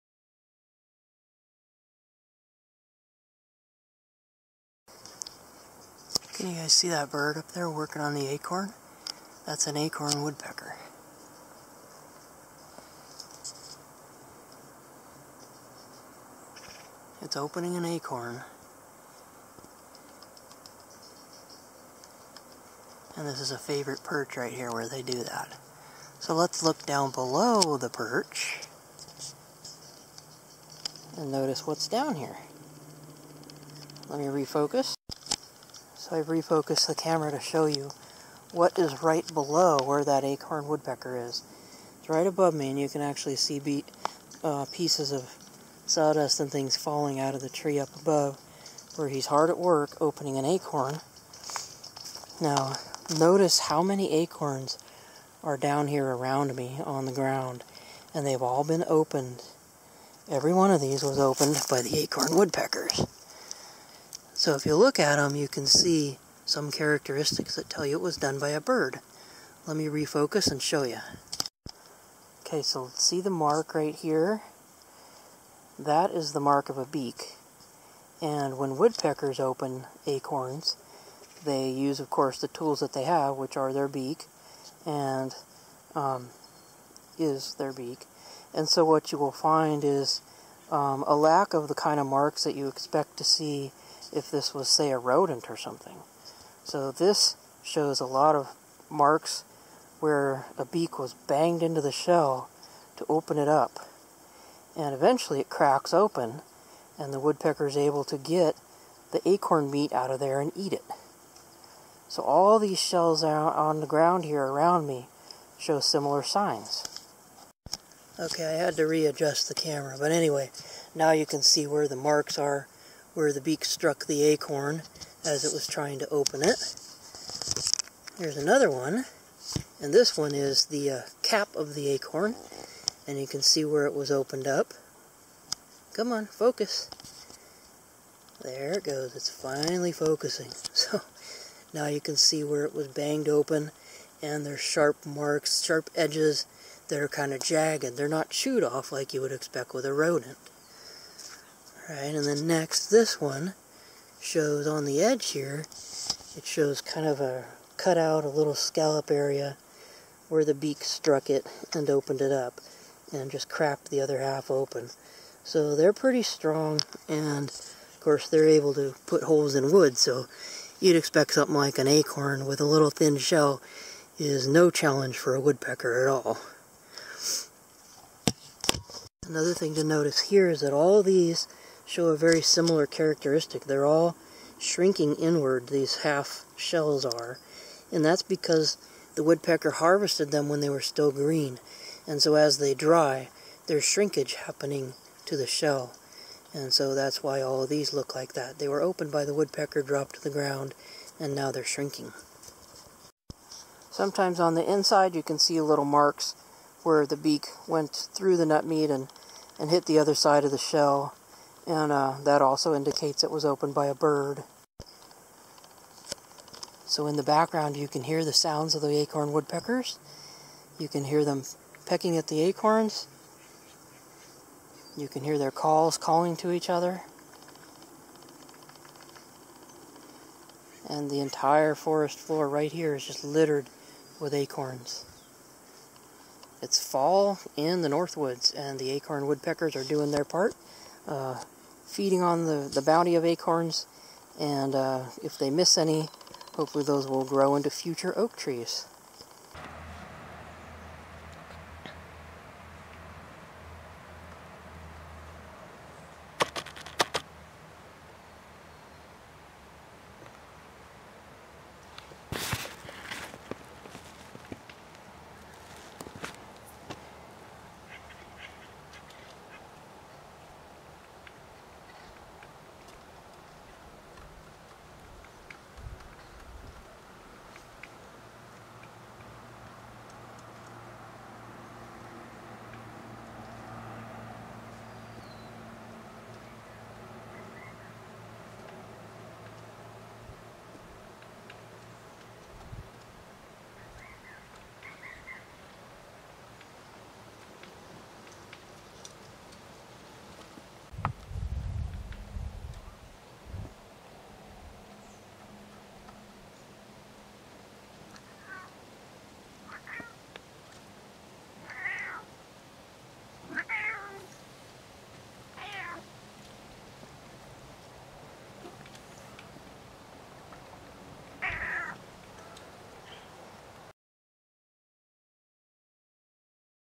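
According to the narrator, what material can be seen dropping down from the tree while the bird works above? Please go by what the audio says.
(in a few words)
Sawdust.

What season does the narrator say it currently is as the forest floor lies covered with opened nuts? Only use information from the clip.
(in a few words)
Fall.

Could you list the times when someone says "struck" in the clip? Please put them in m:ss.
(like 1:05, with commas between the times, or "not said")
2:03, 2:40.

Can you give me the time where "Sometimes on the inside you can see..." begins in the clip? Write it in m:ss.
3:23.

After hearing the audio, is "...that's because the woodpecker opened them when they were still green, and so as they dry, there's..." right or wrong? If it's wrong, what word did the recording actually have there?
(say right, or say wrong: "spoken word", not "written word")
wrong: "harvested", not "opened".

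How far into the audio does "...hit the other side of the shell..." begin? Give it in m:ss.
3:29.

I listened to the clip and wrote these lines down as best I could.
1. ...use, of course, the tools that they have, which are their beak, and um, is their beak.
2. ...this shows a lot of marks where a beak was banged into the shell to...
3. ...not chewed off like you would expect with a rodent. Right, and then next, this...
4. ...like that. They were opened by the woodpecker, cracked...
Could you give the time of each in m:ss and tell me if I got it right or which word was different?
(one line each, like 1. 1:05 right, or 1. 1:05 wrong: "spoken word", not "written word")
1. 1:21 right
2. 1:36 right
3. 2:28 right
4. 3:18 wrong: "dropped", not "cracked".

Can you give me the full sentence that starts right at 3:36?
So in the background you can hear the sounds of the acorn woodpeckers.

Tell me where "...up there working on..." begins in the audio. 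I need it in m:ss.
0:07.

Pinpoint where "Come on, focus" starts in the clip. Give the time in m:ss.
2:15.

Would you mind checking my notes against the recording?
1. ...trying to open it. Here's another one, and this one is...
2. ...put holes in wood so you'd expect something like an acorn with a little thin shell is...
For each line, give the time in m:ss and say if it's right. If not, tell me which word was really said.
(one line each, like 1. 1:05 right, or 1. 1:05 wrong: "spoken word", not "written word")
1. 2:05 right
2. 2:49 right.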